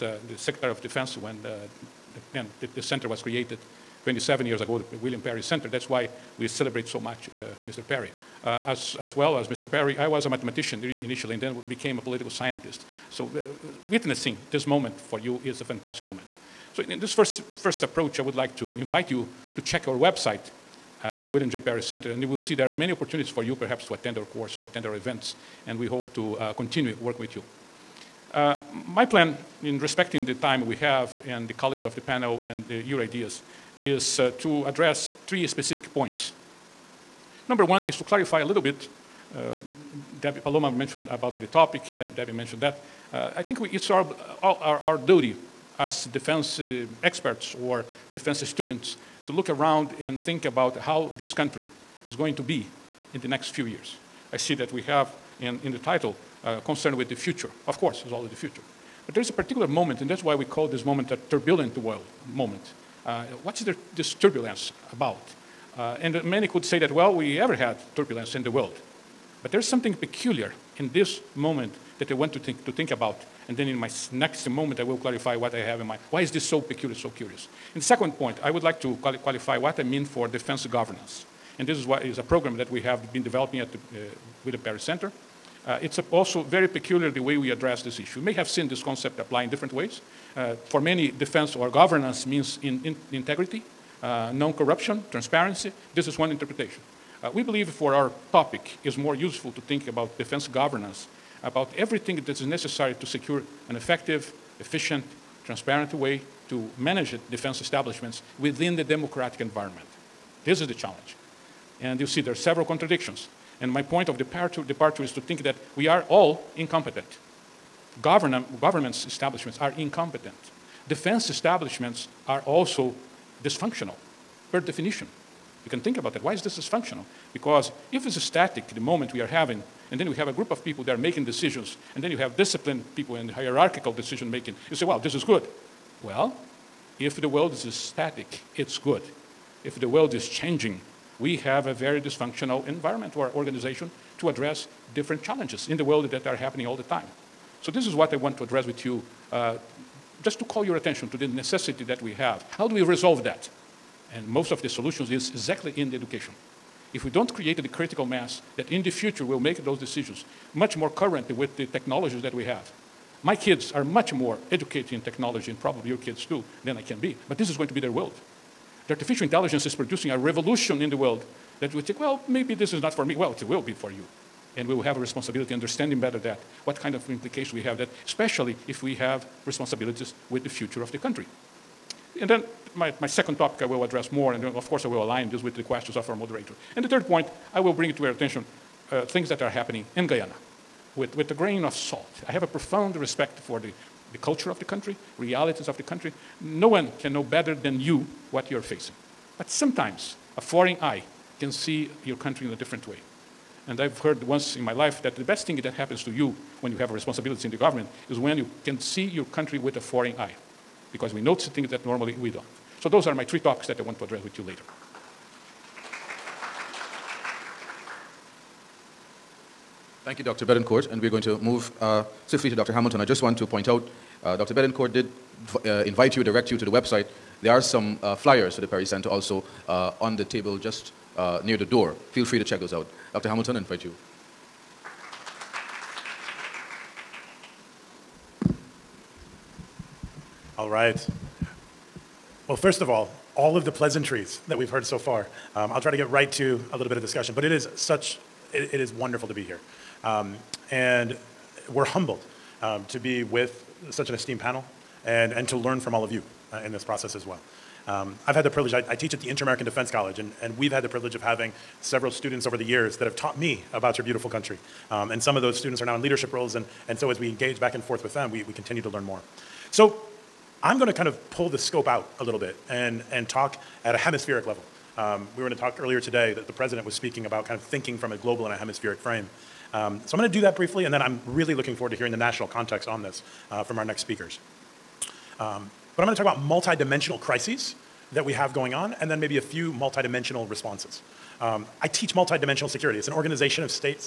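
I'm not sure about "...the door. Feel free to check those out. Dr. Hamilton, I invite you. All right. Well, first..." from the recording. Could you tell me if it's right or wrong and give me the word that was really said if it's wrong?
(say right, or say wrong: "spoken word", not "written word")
right.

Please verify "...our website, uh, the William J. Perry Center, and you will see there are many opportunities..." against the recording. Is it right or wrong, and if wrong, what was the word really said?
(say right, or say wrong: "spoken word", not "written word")
right.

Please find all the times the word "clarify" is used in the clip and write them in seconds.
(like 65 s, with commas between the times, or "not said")
38 s, 74 s.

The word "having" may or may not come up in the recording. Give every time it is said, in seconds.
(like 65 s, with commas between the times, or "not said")
129 s, 261 s.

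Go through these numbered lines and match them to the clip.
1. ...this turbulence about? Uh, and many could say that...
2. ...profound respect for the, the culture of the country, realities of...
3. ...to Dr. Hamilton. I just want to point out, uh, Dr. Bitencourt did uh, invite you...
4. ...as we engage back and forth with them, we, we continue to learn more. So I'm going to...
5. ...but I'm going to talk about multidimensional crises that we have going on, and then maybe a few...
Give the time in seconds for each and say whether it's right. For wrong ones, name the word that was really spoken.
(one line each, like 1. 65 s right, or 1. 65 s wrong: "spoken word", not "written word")
1. 63 s right
2. 192 s right
3. 222 s right
4. 267 s right
5. 285 s right.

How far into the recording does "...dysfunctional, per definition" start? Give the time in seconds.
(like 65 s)
123 s.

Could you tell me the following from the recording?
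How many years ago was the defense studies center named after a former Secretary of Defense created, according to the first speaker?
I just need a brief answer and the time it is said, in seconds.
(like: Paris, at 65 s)
27, at 4 s.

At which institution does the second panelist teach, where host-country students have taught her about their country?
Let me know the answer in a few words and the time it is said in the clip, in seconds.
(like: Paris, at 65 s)
Inter American Defense College, at 259 s.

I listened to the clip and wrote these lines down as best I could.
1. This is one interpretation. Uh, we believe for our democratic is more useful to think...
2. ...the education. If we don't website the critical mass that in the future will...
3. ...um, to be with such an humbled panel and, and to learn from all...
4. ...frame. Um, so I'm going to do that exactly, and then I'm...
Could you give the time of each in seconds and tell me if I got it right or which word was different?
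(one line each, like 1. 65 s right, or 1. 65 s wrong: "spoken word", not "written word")
1. 95 s wrong: "topic", not "democratic"
2. 155 s wrong: "create", not "website"
3. 252 s wrong: "esteemed", not "humbled"
4. 278 s wrong: "briefly", not "exactly".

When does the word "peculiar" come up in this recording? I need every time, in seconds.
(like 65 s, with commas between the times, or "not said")
69 s, 76 s, 86 s.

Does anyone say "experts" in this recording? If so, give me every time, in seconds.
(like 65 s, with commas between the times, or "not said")
47 s.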